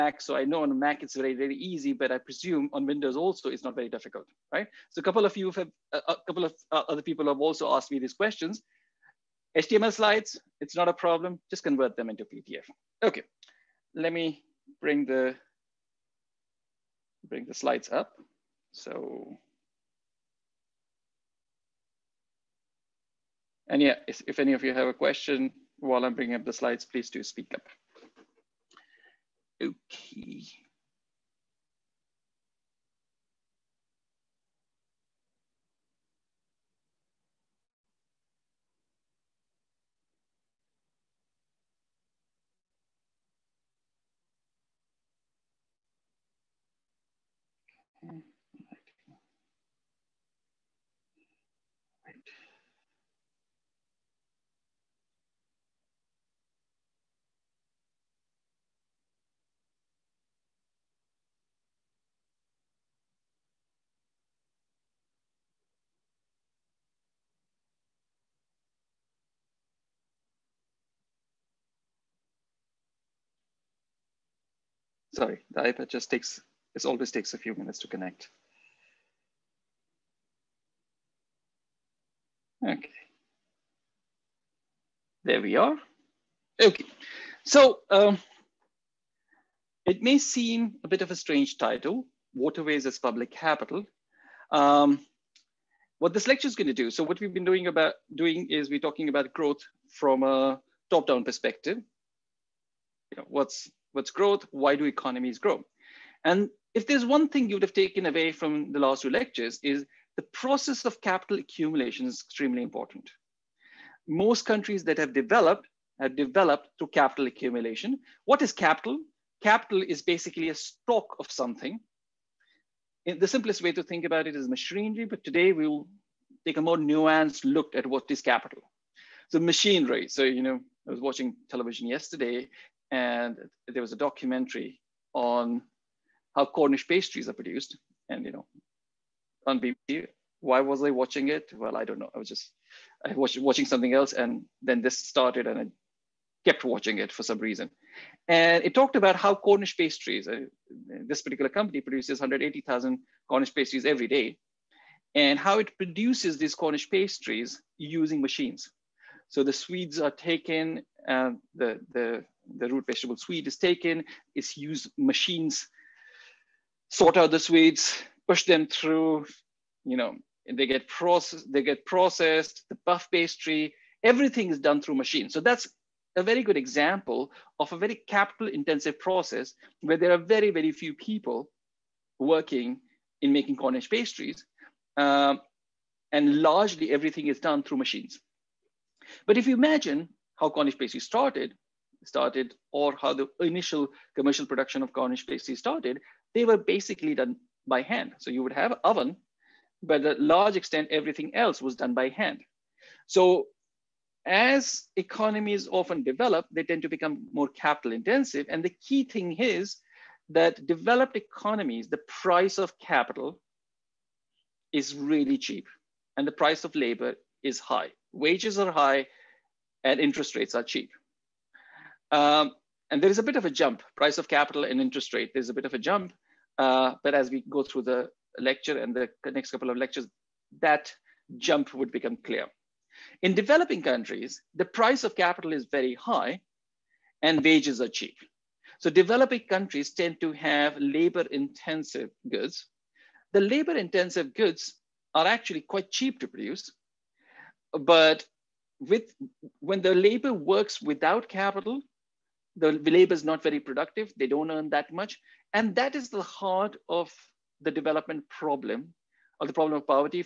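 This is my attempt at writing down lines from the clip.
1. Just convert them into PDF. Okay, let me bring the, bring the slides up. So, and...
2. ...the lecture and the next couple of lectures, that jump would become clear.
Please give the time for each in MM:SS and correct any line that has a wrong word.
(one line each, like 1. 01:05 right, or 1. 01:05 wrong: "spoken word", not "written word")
1. 00:11 right
2. 03:47 right.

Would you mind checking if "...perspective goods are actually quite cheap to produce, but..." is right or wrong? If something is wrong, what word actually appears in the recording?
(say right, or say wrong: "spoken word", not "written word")
wrong: "intensive", not "perspective".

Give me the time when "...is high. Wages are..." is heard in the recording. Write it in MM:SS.
03:37.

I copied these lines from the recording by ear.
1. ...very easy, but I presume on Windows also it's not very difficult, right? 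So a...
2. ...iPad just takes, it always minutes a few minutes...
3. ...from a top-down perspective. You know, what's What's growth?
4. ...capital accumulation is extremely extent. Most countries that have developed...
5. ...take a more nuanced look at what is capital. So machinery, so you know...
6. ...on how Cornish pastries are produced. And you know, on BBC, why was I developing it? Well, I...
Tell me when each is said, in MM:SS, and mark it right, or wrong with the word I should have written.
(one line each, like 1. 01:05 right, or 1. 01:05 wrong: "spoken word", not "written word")
1. 00:01 right
2. 01:15 wrong: "takes", not "minutes"
3. 01:39 right
4. 01:51 wrong: "important", not "extent"
5. 02:06 right
6. 02:15 wrong: "watching", not "developing".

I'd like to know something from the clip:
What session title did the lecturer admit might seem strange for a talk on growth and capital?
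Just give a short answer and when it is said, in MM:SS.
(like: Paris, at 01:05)
Waterways as Public Capital, at 01:32.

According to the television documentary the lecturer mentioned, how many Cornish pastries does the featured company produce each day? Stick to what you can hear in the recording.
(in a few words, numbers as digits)
180,000.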